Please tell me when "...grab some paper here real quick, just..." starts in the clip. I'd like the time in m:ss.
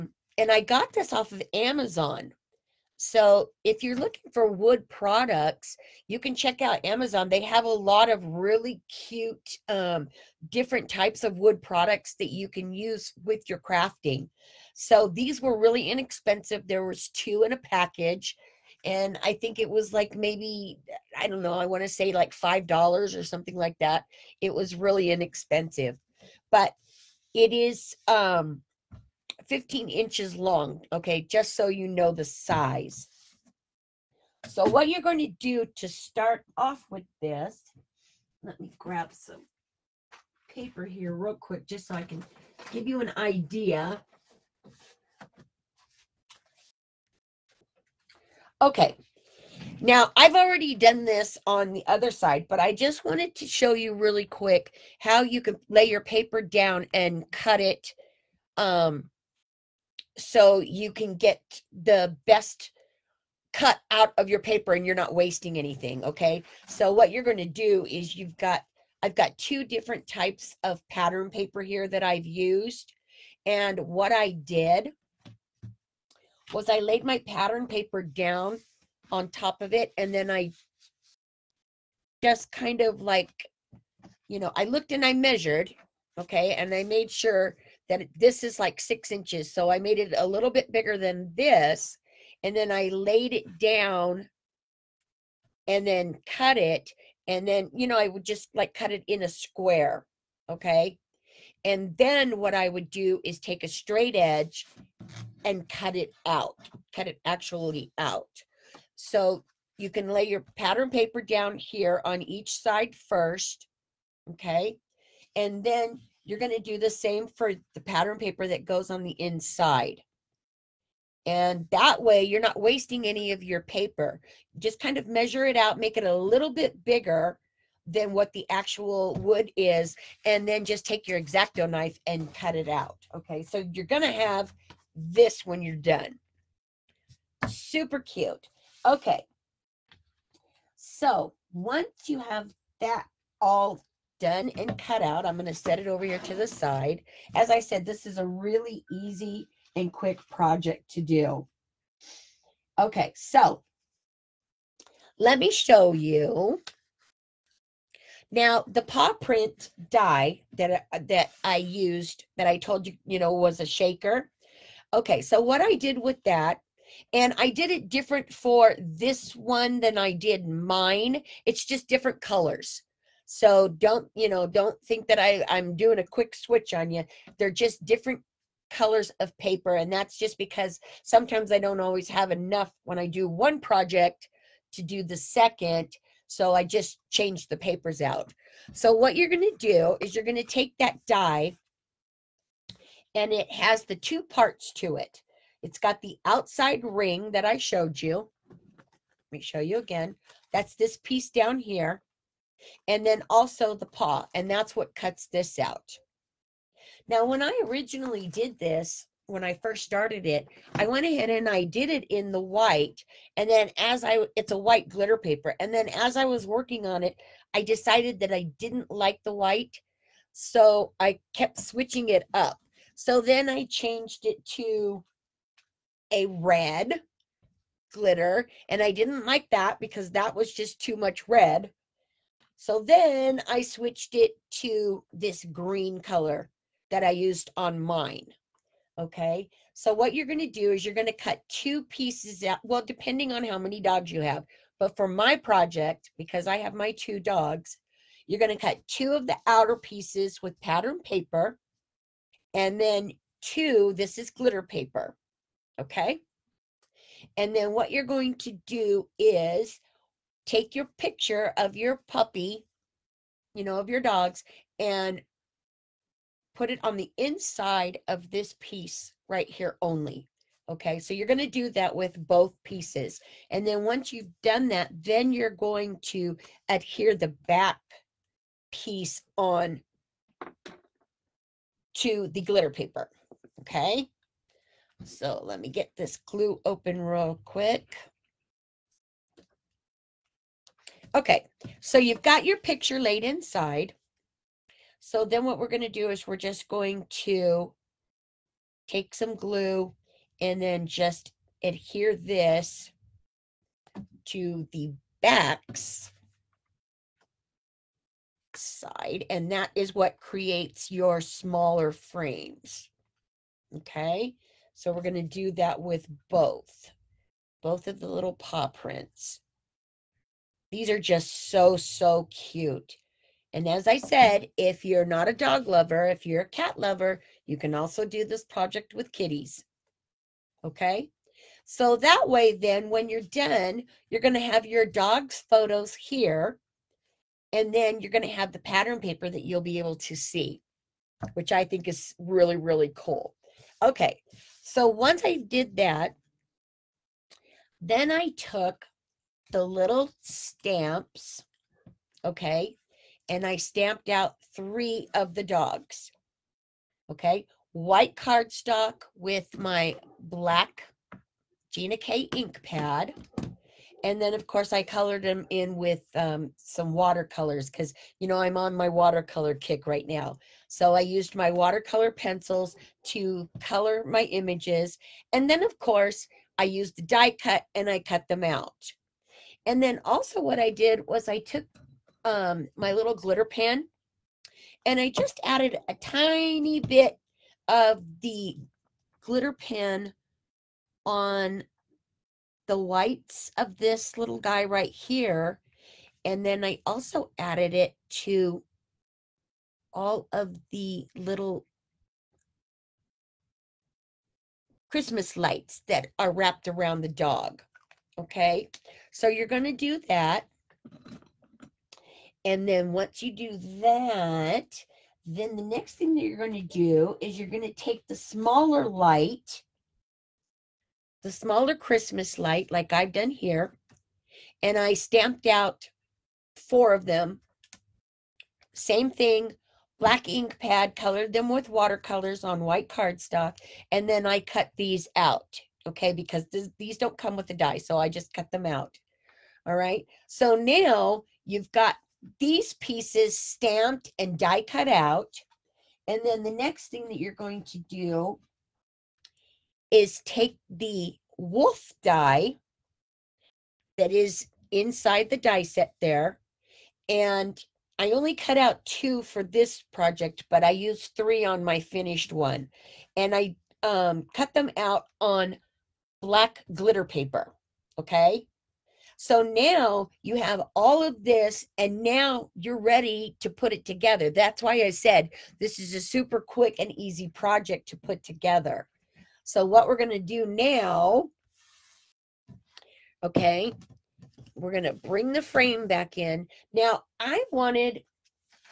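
0:38.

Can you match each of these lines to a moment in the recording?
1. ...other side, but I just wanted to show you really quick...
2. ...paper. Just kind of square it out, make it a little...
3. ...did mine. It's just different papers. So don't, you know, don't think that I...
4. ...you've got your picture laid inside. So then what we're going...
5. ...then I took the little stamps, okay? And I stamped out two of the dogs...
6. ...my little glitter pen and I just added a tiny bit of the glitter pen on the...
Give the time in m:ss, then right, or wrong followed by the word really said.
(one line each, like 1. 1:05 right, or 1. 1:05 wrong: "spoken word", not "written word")
1. 0:51 right
2. 2:03 wrong: "measure", not "square"
3. 2:50 wrong: "colors", not "papers"
4. 4:51 right
5. 5:47 wrong: "three", not "two"
6. 6:22 right.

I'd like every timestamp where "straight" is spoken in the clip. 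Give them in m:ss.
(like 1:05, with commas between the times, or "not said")
1:43.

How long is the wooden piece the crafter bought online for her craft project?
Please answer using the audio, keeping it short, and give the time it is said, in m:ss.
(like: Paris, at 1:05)
15 inches, at 0:29.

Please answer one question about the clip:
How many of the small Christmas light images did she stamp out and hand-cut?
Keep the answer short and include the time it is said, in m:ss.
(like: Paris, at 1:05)
4, at 7:06.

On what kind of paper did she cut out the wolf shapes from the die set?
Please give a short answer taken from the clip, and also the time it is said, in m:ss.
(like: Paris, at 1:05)
black glitter paper, at 7:46.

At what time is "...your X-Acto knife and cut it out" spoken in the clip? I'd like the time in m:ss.
2:11.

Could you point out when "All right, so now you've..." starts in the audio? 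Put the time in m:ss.
7:19.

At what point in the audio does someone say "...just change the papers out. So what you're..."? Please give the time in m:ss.
3:06.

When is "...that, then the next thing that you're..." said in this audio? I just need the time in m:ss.
6:53.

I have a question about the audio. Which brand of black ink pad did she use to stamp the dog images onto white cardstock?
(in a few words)
Gina K.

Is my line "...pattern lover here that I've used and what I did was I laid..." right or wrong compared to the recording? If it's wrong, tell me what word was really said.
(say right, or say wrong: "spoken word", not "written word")
wrong: "paper", not "lover".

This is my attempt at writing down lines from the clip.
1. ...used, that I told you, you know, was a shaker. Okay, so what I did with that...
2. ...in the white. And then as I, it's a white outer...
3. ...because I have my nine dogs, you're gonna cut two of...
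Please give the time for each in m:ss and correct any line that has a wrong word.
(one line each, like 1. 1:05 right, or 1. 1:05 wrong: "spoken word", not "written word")
1. 2:41 right
2. 3:32 wrong: "glitter", not "outer"
3. 4:06 wrong: "two", not "nine".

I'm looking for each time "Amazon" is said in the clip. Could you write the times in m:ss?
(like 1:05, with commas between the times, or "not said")
0:01, 0:06.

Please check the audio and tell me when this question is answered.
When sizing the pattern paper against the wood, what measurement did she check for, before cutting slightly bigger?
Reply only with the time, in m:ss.
1:28.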